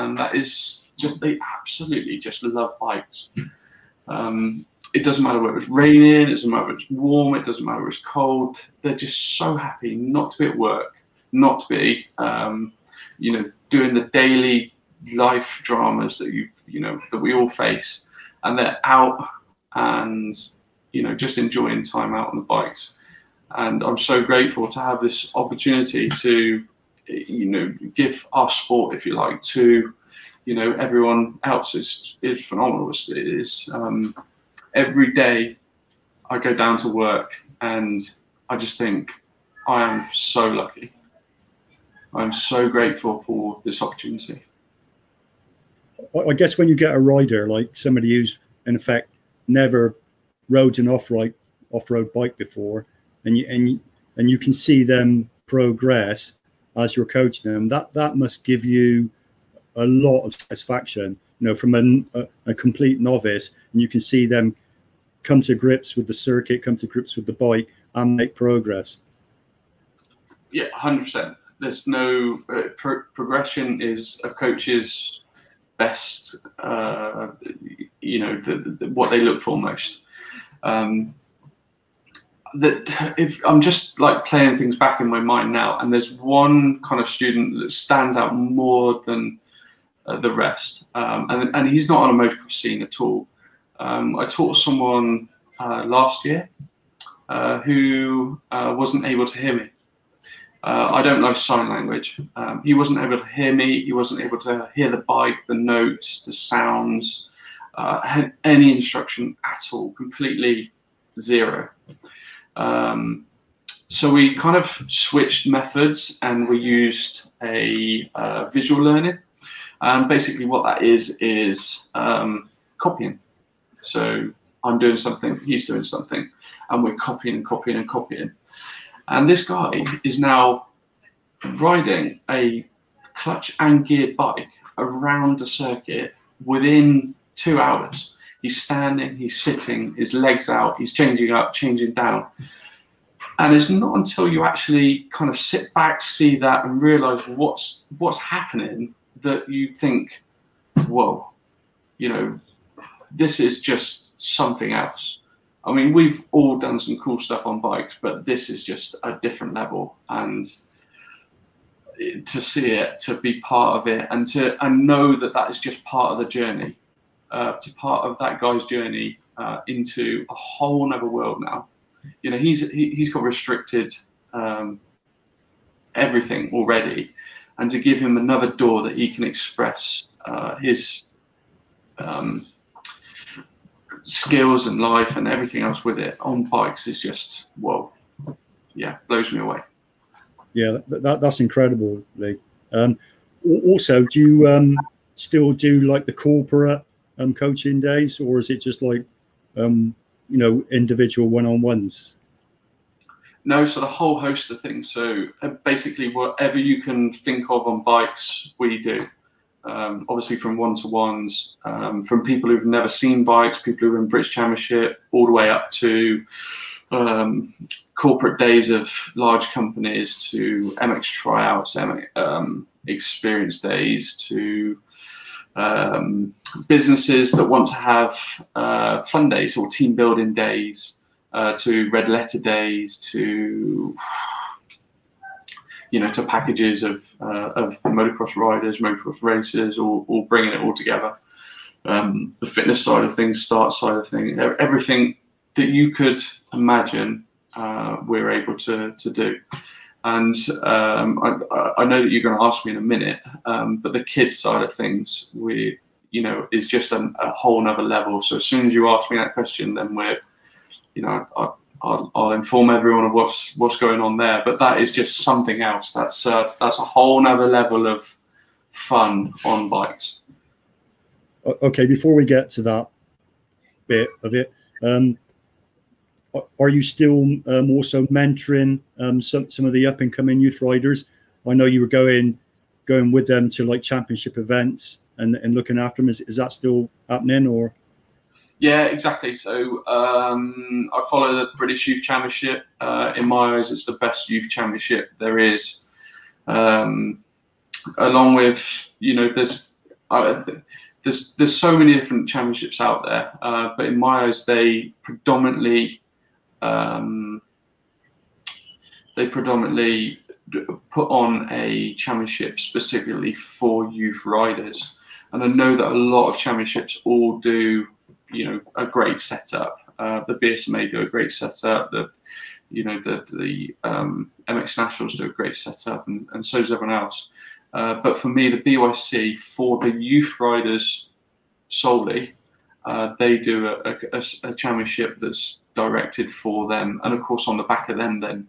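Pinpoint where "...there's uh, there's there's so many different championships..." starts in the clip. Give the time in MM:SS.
04:59.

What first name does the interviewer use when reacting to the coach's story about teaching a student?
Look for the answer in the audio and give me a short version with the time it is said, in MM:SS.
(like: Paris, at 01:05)
Lee, at 03:12.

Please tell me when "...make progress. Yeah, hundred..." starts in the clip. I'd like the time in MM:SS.
01:08.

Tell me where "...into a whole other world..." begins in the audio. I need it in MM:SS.
02:49.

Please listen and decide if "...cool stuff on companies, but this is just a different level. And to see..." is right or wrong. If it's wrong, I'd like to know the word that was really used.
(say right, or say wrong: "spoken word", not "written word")
wrong: "bikes", not "companies".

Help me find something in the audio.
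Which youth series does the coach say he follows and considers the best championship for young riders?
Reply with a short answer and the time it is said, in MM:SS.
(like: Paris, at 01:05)
British Youth Championship, at 04:51.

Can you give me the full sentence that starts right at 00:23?
And I'm so grateful to have this opportunity to you know give our sport, if you like, to you know everyone else.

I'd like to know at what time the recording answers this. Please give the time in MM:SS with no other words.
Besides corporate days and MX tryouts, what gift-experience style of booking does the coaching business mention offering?
03:51.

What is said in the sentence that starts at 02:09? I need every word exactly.
And this guy is now riding a clutch and gear bike around the circuit within two hours.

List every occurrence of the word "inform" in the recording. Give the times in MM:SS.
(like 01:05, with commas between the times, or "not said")
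04:22.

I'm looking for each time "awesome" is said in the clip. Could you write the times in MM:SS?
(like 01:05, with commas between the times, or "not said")
not said.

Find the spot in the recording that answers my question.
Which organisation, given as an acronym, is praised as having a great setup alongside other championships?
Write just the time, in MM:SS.
05:20.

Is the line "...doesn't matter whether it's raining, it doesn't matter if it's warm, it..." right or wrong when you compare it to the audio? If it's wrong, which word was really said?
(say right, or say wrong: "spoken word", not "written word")
right.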